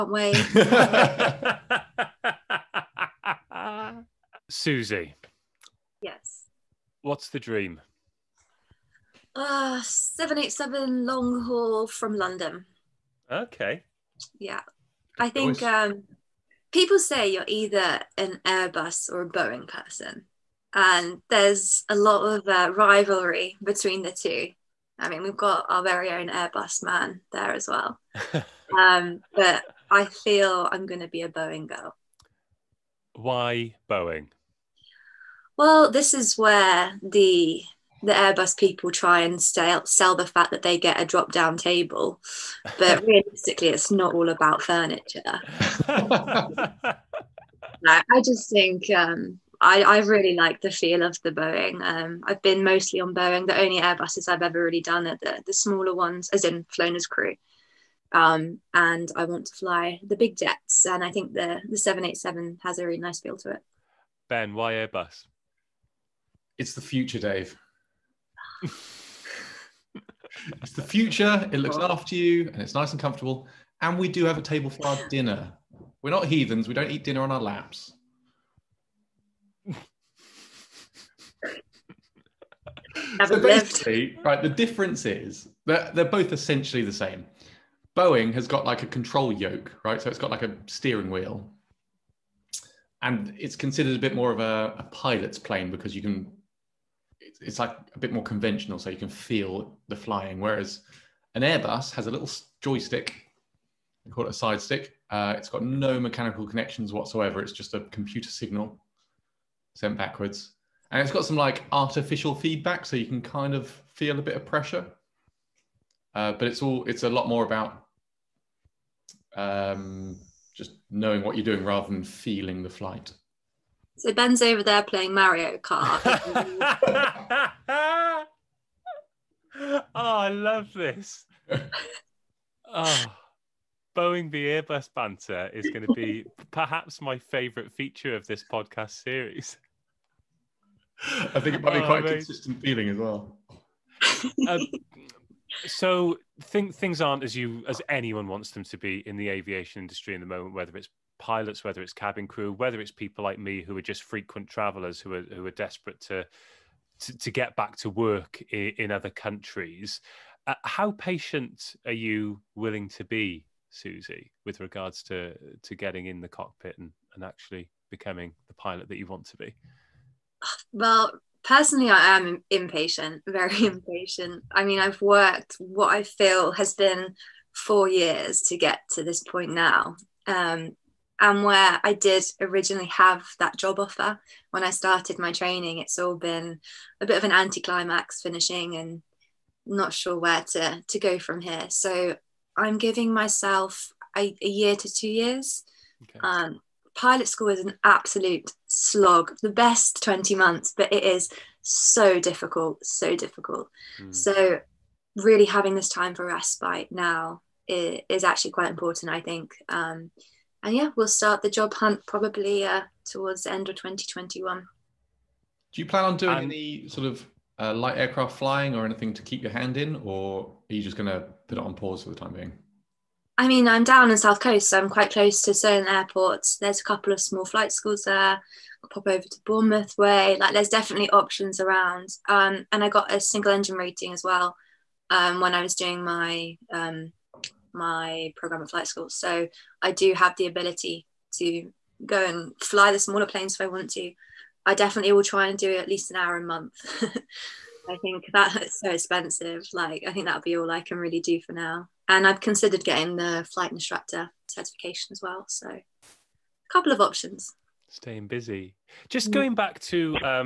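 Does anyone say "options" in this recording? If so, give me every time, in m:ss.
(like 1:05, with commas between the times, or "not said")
3:51, 4:17.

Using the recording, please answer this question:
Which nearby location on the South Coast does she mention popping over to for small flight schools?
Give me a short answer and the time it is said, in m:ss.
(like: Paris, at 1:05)
Bournemouth, at 3:49.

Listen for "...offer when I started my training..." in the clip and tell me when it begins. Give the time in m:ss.
3:03.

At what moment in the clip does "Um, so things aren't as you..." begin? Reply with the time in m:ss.
2:24.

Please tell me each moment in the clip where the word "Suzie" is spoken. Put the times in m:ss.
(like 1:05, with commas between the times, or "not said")
0:04, 2:43.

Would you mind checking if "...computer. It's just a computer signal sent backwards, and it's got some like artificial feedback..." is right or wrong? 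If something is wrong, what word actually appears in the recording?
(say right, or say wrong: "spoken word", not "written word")
wrong: "whatsoever", not "computer".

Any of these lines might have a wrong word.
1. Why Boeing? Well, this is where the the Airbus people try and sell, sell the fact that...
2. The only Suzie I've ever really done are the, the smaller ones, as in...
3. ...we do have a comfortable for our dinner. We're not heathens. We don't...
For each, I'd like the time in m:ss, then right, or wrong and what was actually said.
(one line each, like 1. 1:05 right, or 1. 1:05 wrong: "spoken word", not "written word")
1. 0:33 right
2. 0:53 wrong: "Airbuses", not "Suzie"
3. 1:13 wrong: "table", not "comfortable".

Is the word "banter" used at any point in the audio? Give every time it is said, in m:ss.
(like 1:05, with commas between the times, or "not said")
2:14.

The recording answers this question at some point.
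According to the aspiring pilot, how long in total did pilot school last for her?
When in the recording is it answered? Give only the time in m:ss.
3:20.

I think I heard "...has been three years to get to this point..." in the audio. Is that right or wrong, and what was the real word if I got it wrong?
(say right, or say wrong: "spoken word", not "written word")
wrong: "four", not "three".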